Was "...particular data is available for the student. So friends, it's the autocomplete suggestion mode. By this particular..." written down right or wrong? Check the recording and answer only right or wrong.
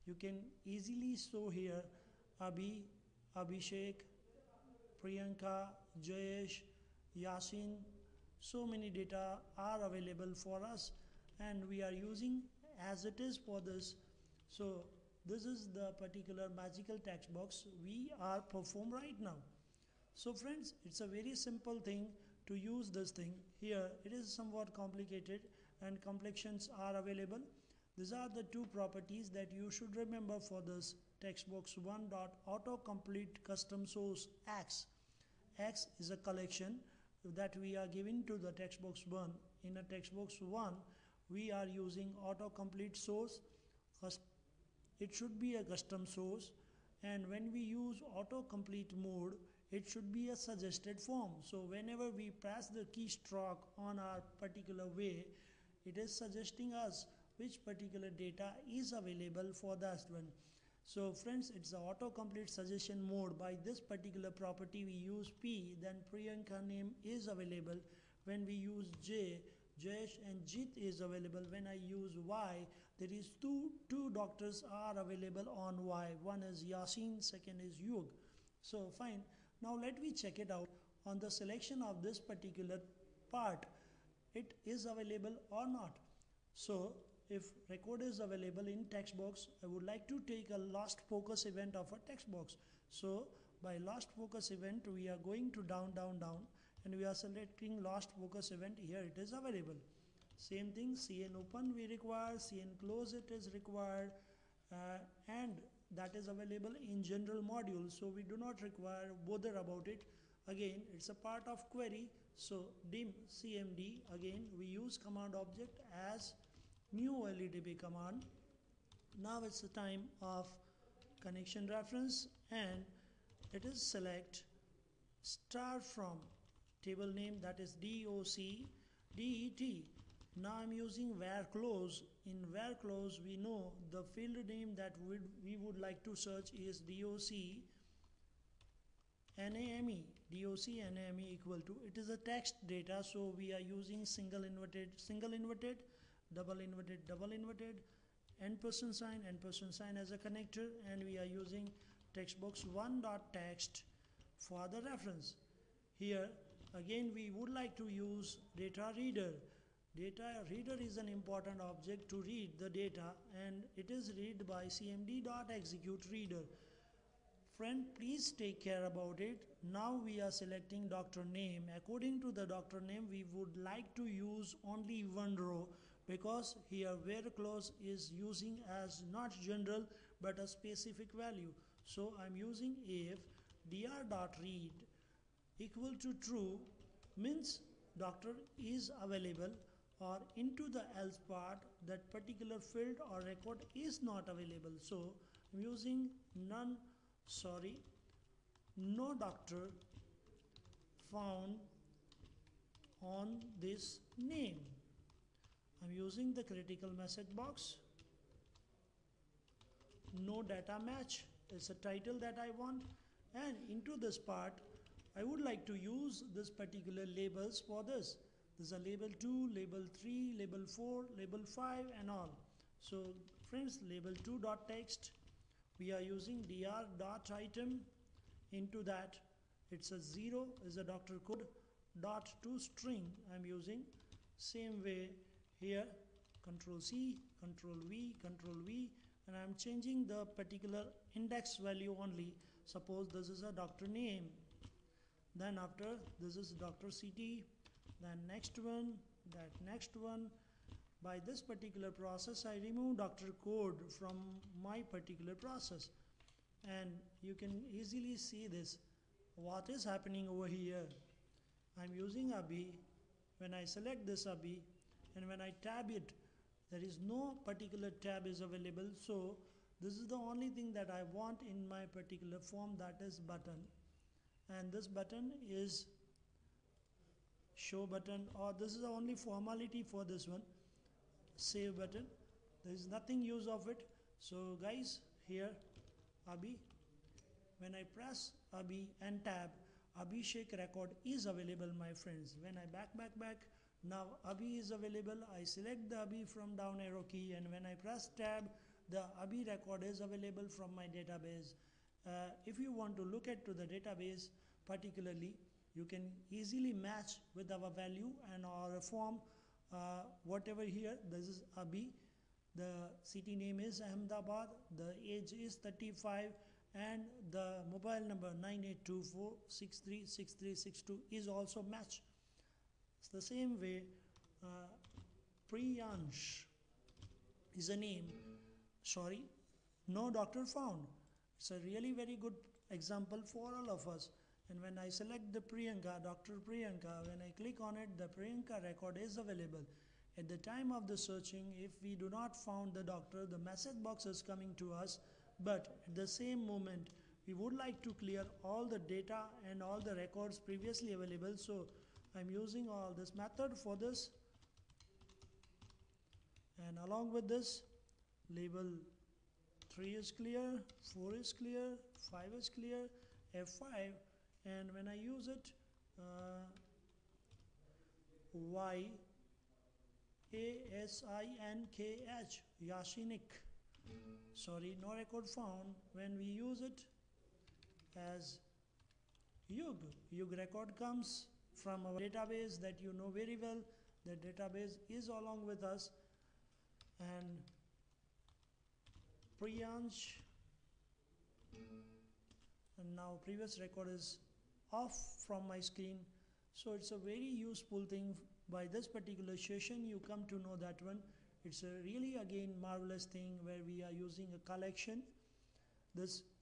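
right.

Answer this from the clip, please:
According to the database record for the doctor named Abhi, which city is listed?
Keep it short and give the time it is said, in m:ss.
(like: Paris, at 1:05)
Ahmedabad, at 5:13.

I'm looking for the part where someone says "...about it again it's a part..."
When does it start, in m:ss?
1:49.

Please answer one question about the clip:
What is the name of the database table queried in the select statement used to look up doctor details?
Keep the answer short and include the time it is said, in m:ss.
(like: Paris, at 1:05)
DOC DET, at 2:07.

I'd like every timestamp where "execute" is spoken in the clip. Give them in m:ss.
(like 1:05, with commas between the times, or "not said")
2:45.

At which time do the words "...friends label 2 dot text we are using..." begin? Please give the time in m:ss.
3:43.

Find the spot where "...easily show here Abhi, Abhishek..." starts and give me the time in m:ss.
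0:00.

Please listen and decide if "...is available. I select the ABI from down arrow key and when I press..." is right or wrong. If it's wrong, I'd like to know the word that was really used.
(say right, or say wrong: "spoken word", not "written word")
right.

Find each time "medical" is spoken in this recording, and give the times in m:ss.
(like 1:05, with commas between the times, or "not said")
not said.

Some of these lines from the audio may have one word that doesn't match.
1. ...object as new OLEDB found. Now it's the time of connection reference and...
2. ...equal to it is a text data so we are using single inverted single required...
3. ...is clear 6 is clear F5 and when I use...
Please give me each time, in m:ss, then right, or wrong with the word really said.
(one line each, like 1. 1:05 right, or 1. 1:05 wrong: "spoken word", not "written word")
1. 1:55 wrong: "command", not "found"
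2. 2:21 wrong: "inverted", not "required"
3. 6:01 wrong: "5", not "6".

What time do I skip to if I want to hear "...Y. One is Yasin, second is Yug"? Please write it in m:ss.
1:15.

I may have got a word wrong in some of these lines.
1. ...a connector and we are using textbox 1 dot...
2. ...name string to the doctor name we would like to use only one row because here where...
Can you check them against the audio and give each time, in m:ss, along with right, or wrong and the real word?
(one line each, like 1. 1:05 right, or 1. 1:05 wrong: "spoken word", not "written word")
1. 2:30 right
2. 2:51 wrong: "according", not "string".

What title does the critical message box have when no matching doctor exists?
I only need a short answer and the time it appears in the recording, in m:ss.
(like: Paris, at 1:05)
No data match, at 3:30.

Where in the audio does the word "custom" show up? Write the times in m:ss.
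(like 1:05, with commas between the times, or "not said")
0:33, 0:45.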